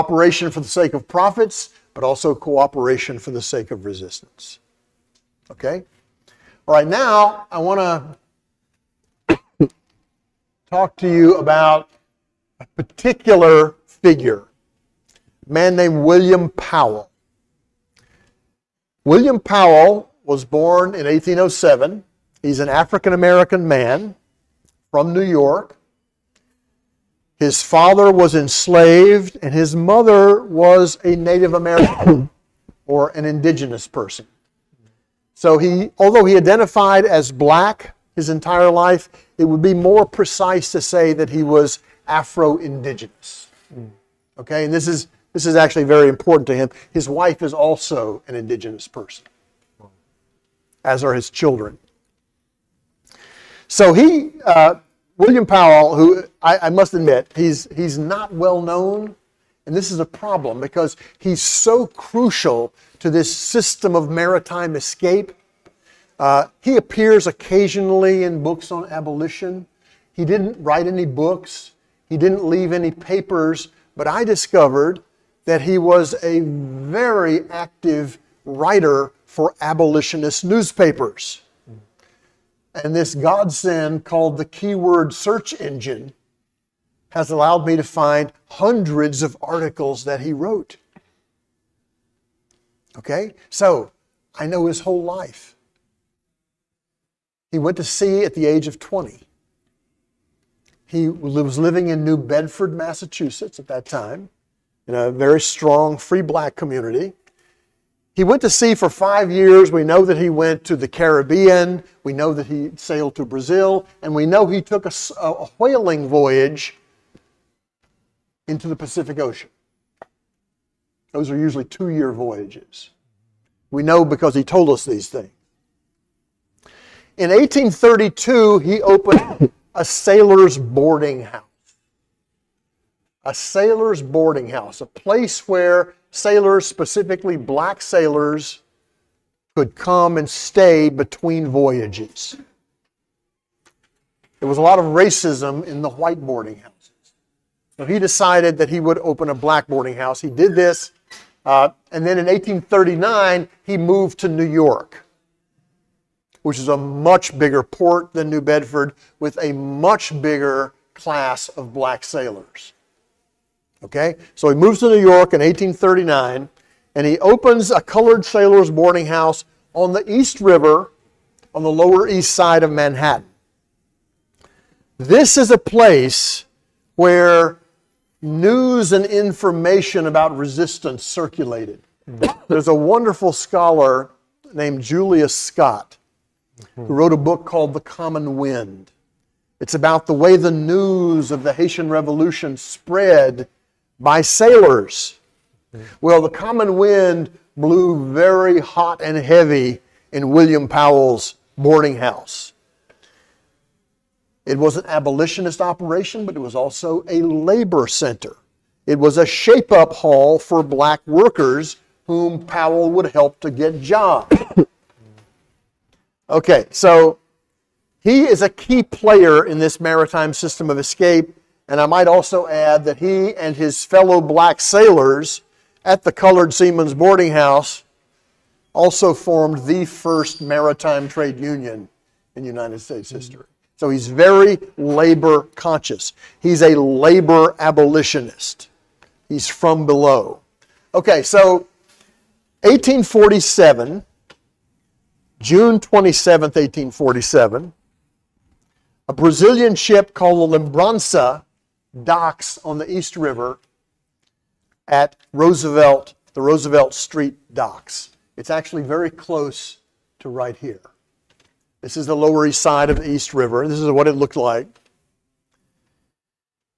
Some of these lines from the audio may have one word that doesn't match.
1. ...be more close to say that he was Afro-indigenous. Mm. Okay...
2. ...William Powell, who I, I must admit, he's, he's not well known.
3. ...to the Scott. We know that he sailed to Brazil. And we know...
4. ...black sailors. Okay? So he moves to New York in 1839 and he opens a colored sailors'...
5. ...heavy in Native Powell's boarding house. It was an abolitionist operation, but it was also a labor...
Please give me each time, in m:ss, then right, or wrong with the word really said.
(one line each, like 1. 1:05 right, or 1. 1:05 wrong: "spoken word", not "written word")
1. 0:39 wrong: "precise", not "close"
2. 0:55 right
3. 1:50 wrong: "Caribbean", not "Scott"
4. 2:41 right
5. 3:19 wrong: "William", not "Native".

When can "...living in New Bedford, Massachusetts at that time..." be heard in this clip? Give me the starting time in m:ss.
1:41.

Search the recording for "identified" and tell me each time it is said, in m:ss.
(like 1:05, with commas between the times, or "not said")
0:36.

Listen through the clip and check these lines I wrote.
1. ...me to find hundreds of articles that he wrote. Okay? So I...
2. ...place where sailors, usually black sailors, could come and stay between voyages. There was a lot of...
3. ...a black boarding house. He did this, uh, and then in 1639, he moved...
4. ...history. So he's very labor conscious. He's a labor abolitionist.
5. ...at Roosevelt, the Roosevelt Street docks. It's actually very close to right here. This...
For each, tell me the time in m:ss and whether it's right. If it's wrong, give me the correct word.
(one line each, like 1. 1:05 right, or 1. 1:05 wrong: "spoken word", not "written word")
1. 1:27 right
2. 2:14 wrong: "specifically", not "usually"
3. 2:29 wrong: "1839", not "1639"
4. 3:53 right
5. 4:14 right.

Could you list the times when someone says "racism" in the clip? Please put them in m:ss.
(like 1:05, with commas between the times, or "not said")
2:24.